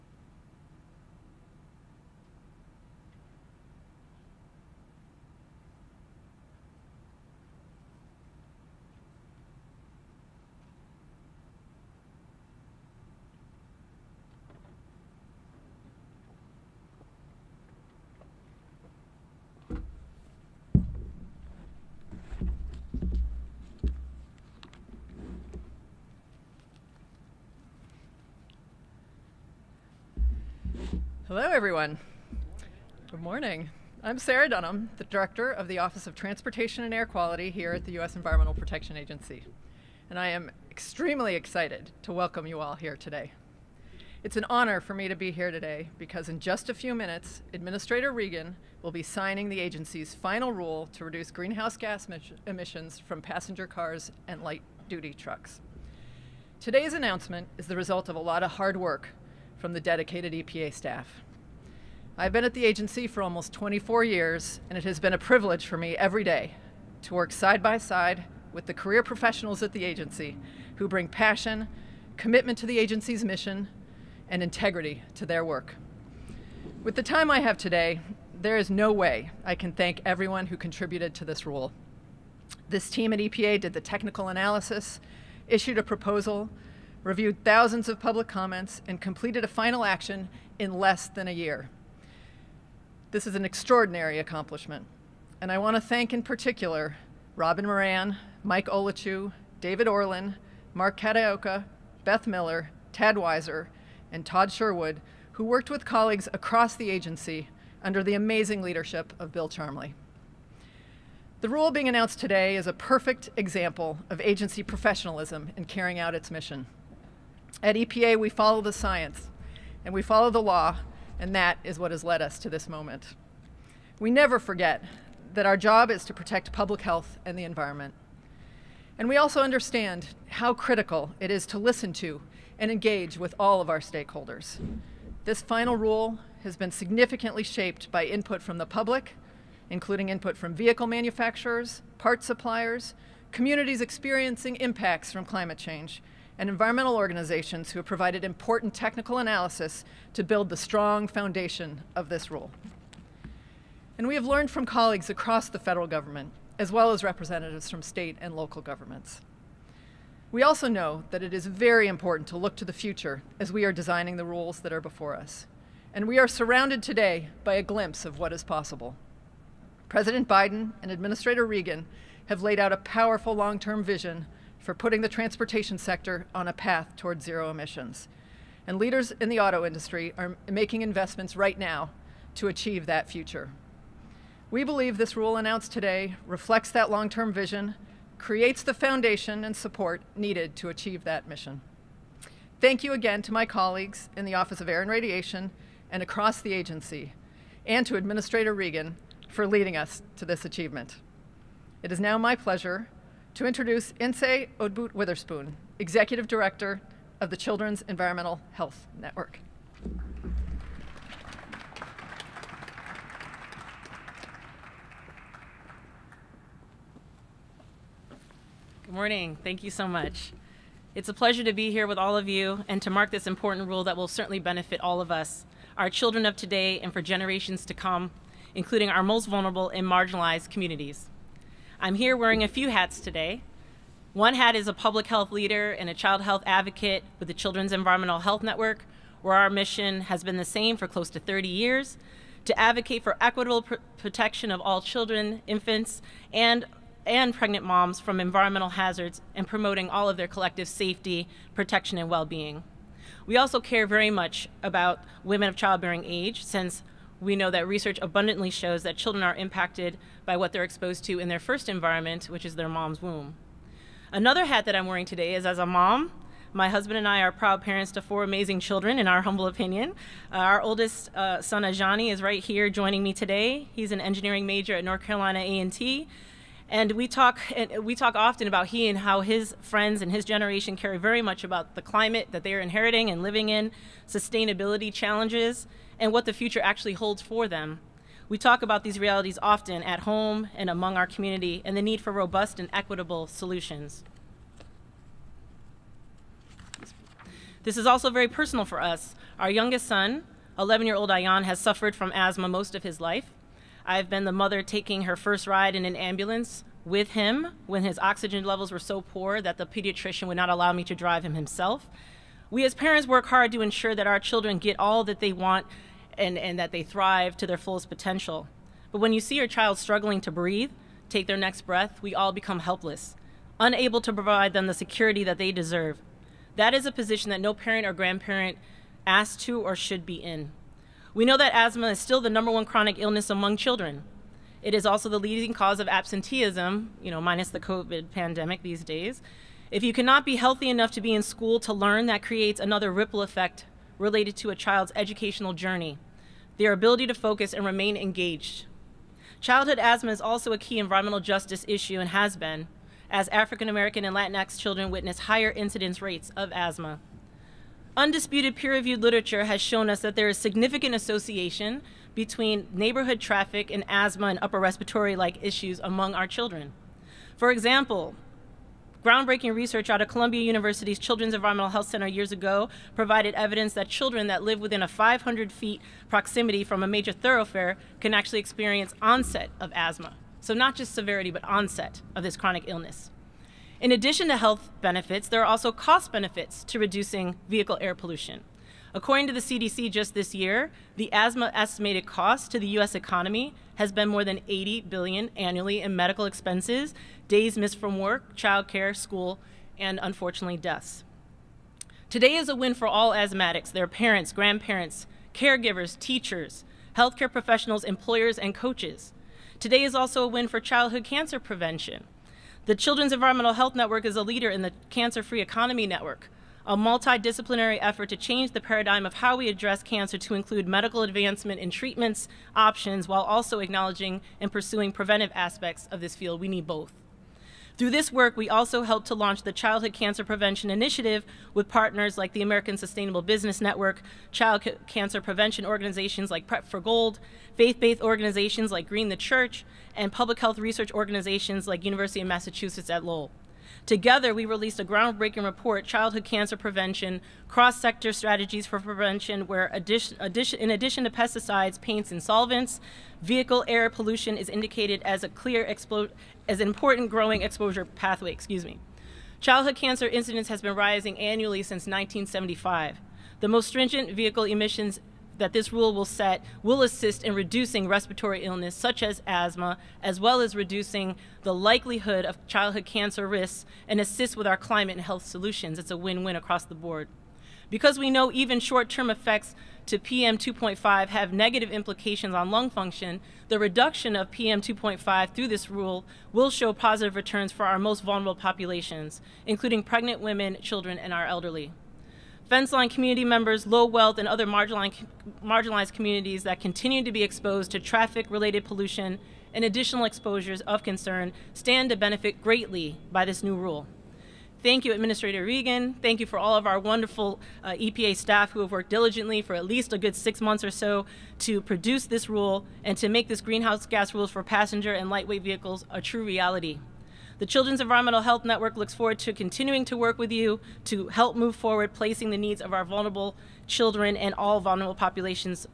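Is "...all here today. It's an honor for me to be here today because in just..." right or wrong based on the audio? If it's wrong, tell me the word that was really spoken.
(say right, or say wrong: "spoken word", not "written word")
right.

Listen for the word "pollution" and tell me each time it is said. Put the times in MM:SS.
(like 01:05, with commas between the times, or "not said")
06:27, 07:33, 08:18.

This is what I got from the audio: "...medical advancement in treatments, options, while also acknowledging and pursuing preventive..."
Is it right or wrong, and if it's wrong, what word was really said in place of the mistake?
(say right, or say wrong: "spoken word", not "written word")
right.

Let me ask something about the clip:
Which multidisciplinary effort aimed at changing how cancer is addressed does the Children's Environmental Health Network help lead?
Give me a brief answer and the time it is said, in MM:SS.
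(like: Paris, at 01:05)
Cancer Free Economy Network, at 06:54.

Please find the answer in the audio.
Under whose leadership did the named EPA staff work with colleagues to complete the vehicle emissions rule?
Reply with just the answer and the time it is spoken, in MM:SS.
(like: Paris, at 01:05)
Bill Charmley, at 01:49.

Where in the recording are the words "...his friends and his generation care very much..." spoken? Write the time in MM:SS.
04:39.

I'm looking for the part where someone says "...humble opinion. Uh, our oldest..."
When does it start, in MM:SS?
04:29.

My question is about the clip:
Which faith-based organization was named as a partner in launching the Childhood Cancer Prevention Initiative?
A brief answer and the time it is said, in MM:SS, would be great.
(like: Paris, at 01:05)
Green the Church, at 07:18.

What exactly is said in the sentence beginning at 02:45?
And we are surrounded today by a glimpse of what is possible.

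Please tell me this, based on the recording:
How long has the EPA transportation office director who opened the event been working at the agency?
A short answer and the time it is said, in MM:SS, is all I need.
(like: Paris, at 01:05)
almost 24 years, at 01:03.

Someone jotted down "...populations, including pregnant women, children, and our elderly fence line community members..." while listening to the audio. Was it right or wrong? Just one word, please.
right.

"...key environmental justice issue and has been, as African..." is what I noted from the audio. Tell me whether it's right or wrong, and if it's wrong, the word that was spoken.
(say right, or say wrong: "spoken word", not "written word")
right.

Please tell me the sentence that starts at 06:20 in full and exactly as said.
So, not just severity, but onset of this chronic illness.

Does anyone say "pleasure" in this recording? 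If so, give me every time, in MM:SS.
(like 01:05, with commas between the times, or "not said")
03:22, 03:41.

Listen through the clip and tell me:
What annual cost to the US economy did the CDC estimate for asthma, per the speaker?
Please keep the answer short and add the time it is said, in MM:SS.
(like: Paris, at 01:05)
more than $80 billion, at 06:34.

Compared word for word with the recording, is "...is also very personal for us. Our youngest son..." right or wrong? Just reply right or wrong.
right.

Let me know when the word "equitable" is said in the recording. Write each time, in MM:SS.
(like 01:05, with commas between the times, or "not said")
04:03, 04:52.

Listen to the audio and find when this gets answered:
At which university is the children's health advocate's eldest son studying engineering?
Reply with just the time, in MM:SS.
04:34.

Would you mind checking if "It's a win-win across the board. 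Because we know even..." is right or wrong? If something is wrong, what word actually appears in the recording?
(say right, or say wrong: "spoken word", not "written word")
right.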